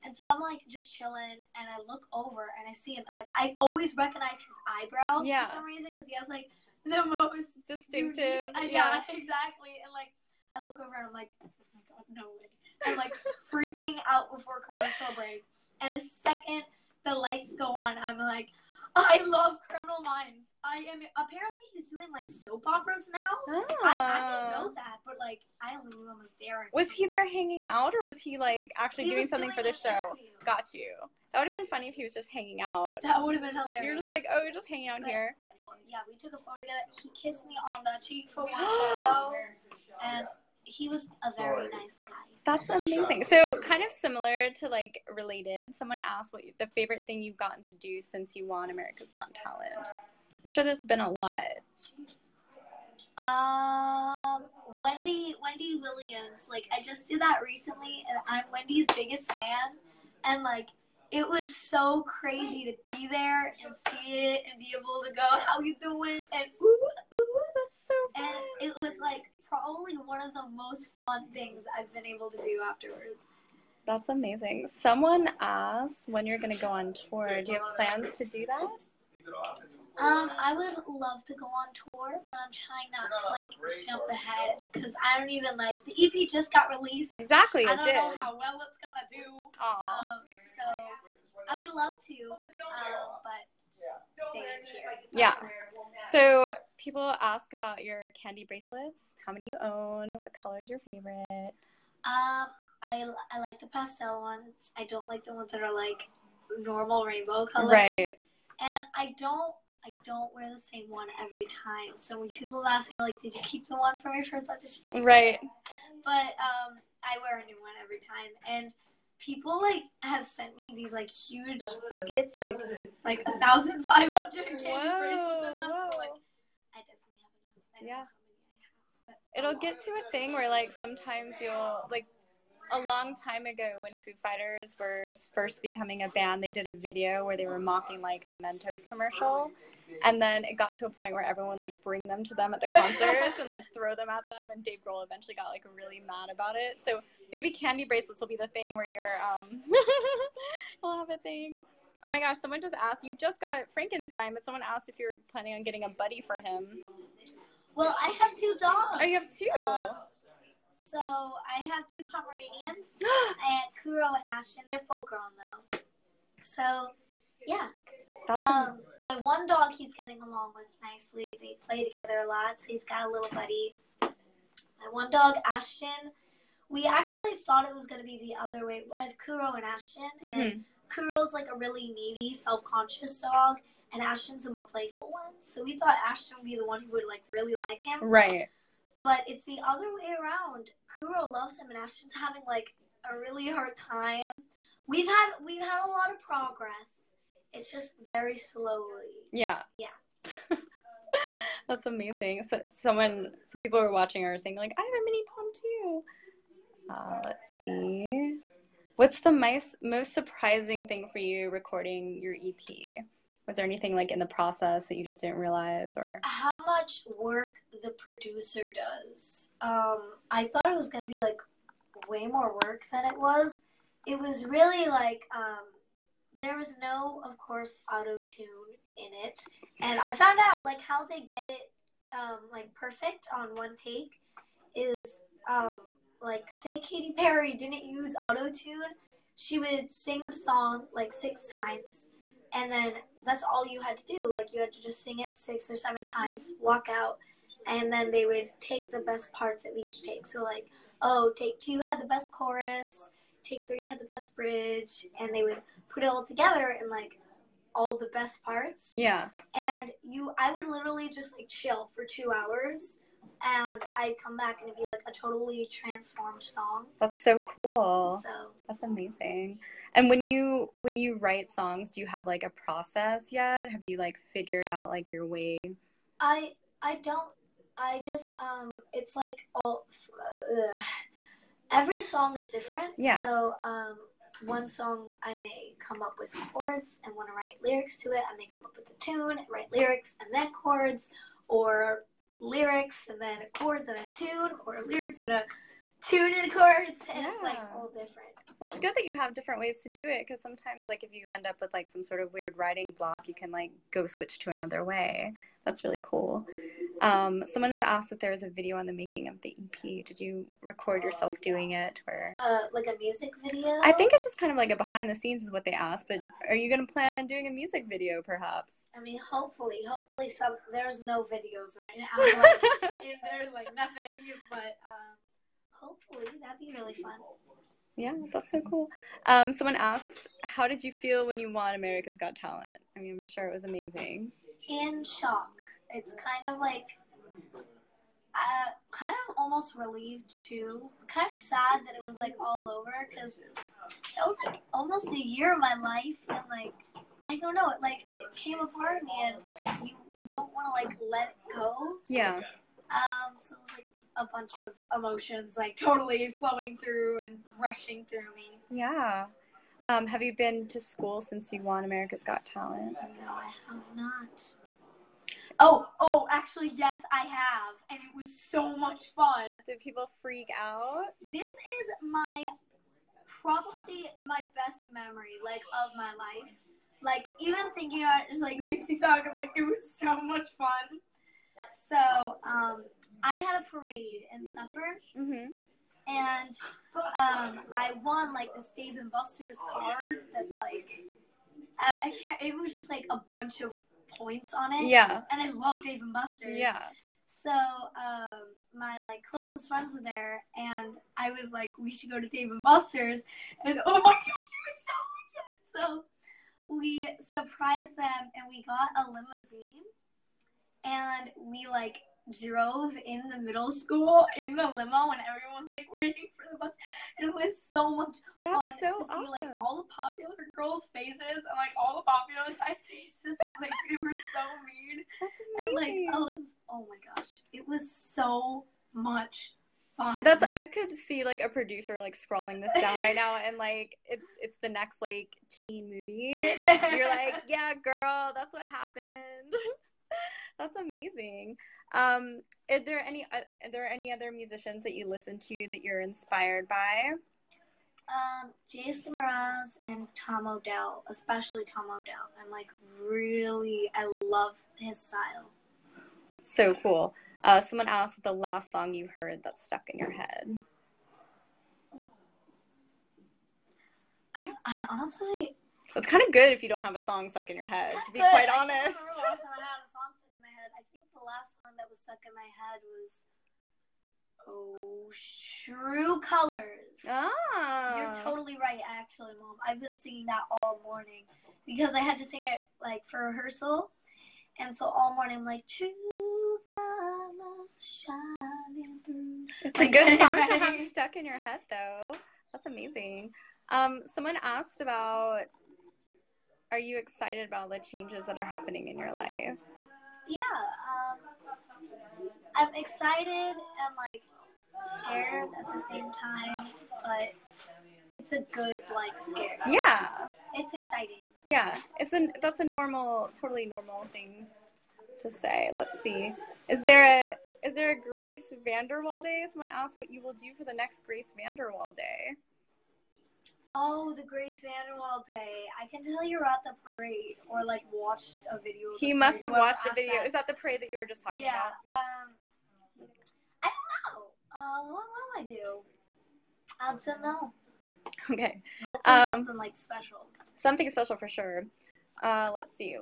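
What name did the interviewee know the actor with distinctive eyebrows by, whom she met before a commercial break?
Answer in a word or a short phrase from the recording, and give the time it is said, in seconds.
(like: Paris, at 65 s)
Darren, at 26 s.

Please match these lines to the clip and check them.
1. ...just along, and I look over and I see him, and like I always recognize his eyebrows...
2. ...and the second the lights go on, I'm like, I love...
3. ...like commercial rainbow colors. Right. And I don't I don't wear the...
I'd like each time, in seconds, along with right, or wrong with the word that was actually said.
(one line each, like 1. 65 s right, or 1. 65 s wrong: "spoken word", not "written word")
1. 0 s wrong: "chilling", not "along"
2. 15 s right
3. 105 s wrong: "normal", not "commercial".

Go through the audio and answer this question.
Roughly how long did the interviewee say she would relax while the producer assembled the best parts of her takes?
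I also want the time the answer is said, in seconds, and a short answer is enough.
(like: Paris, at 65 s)
2 hours, at 262 s.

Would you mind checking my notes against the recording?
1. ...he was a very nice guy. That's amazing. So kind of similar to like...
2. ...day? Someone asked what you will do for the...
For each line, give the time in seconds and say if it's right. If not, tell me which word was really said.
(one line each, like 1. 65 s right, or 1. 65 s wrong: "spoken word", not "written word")
1. 40 s right
2. 519 s right.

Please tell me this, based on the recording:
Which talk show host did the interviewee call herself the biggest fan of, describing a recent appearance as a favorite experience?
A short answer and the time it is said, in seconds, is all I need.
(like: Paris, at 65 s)
Wendy Williams, at 55 s.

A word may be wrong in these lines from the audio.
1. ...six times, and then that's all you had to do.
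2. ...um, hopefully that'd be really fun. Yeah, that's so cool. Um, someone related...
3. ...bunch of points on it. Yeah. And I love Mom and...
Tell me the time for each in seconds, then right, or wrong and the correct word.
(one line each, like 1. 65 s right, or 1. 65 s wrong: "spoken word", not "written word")
1. 241 s right
2. 324 s wrong: "asked", not "related"
3. 393 s wrong: "Dave", not "Mom".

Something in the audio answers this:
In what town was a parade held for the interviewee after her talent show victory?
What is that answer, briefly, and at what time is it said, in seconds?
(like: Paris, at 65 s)
Suffern, at 384 s.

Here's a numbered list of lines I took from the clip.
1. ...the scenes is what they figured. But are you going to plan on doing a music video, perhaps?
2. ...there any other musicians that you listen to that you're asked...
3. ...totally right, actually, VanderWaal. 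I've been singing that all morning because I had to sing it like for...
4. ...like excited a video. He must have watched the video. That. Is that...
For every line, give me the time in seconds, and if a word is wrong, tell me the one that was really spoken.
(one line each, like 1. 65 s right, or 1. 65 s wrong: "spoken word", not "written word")
1. 315 s wrong: "asked", not "figured"
2. 443 s wrong: "inspired", not "asked"
3. 478 s wrong: "Mom", not "VanderWaal"
4. 527 s wrong: "watched", not "excited".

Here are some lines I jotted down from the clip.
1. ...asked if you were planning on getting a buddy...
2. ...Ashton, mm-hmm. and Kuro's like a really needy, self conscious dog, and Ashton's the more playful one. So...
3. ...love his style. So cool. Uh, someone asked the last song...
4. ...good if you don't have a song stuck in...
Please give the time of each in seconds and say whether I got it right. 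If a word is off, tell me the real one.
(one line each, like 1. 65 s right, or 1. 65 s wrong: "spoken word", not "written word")
1. 154 s right
2. 179 s right
3. 454 s right
4. 466 s right.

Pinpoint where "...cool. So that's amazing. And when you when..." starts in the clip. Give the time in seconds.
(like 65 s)
267 s.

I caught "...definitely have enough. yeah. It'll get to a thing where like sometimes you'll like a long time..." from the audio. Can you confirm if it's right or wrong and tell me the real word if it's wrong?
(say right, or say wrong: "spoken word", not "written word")
right.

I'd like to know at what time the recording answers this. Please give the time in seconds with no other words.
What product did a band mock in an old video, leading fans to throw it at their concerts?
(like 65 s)
138 s.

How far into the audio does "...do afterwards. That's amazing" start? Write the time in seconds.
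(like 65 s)
72 s.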